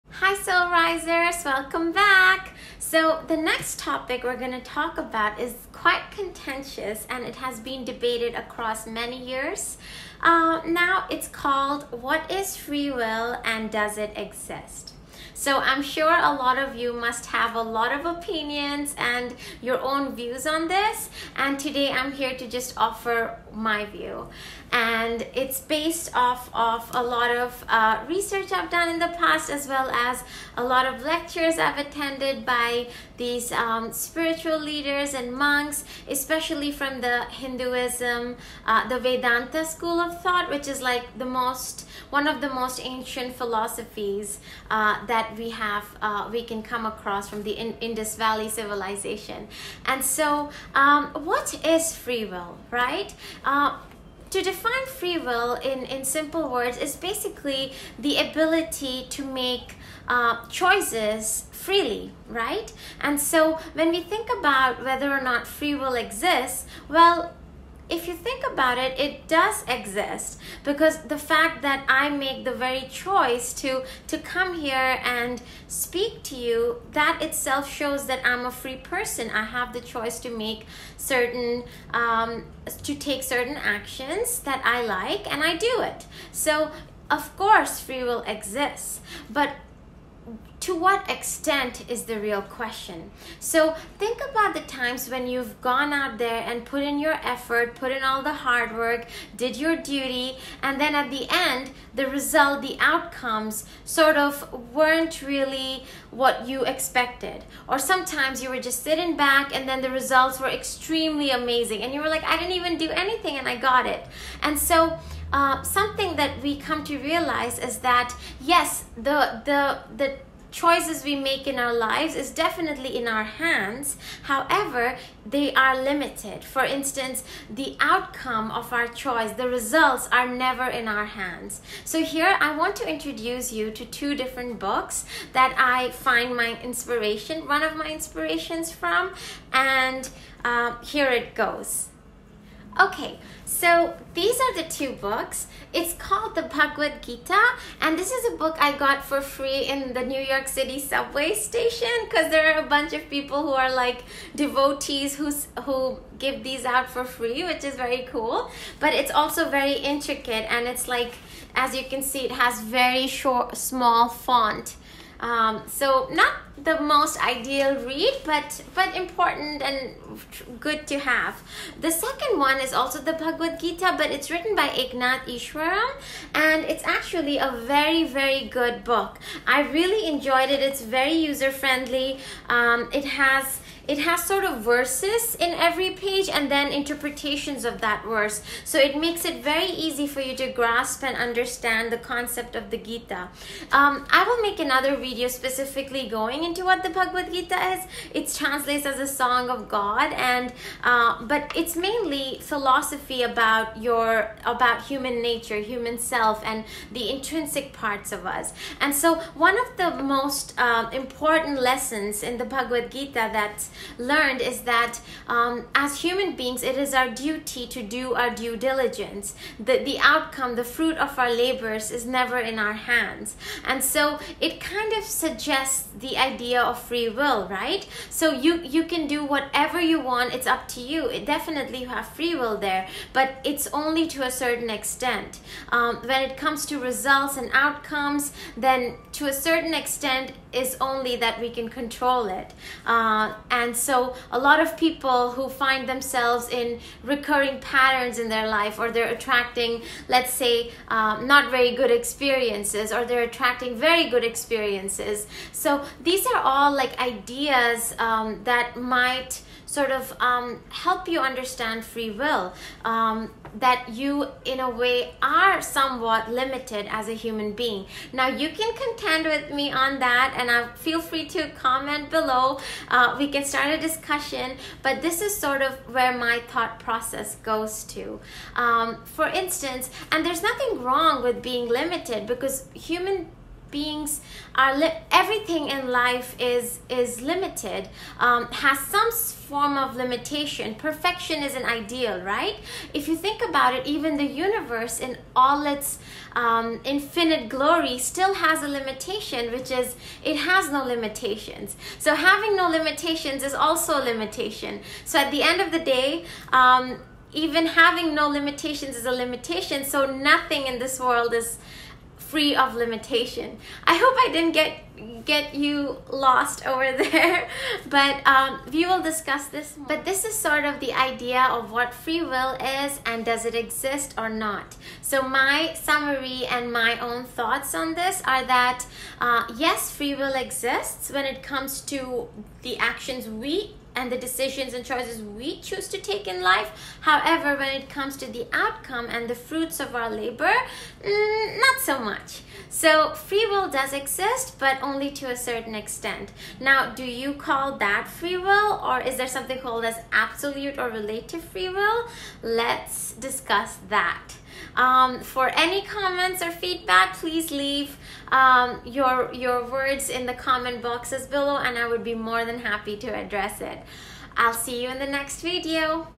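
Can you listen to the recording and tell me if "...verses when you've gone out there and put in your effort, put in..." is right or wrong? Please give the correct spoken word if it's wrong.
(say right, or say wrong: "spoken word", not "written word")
wrong: "times", not "verses".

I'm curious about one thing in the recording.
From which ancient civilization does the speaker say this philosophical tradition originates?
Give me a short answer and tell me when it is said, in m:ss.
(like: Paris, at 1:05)
Indus Valley civilization, at 0:47.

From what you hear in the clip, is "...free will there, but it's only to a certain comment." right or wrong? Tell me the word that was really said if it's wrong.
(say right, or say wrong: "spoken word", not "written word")
wrong: "extent", not "comment".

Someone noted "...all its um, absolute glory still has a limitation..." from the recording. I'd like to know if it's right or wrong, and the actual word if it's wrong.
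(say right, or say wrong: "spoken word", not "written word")
wrong: "infinite", not "absolute".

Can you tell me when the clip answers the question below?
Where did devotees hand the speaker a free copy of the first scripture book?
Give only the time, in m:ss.
2:30.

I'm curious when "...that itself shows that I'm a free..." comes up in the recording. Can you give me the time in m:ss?
1:16.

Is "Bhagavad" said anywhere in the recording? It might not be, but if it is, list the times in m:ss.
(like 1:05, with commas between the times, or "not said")
2:26, 2:53, 3:16, 3:32.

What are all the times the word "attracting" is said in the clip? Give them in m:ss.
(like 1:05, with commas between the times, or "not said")
4:09, 4:13.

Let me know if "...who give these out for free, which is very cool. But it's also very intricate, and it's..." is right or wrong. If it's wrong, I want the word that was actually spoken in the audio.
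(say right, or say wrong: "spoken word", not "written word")
right.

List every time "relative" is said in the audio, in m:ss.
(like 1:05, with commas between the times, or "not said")
5:50.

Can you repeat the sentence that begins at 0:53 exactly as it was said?
Uh, to define free will in, in simple words is basically the ability to make uh, choices freely, right?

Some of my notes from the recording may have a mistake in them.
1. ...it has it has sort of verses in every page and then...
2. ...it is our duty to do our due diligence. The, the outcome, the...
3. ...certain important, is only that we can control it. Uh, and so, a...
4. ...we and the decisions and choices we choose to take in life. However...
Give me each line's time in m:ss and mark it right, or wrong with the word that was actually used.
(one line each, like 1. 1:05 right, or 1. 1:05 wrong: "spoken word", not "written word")
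1. 3:02 right
2. 3:36 right
3. 3:59 wrong: "extent", not "important"
4. 5:33 right.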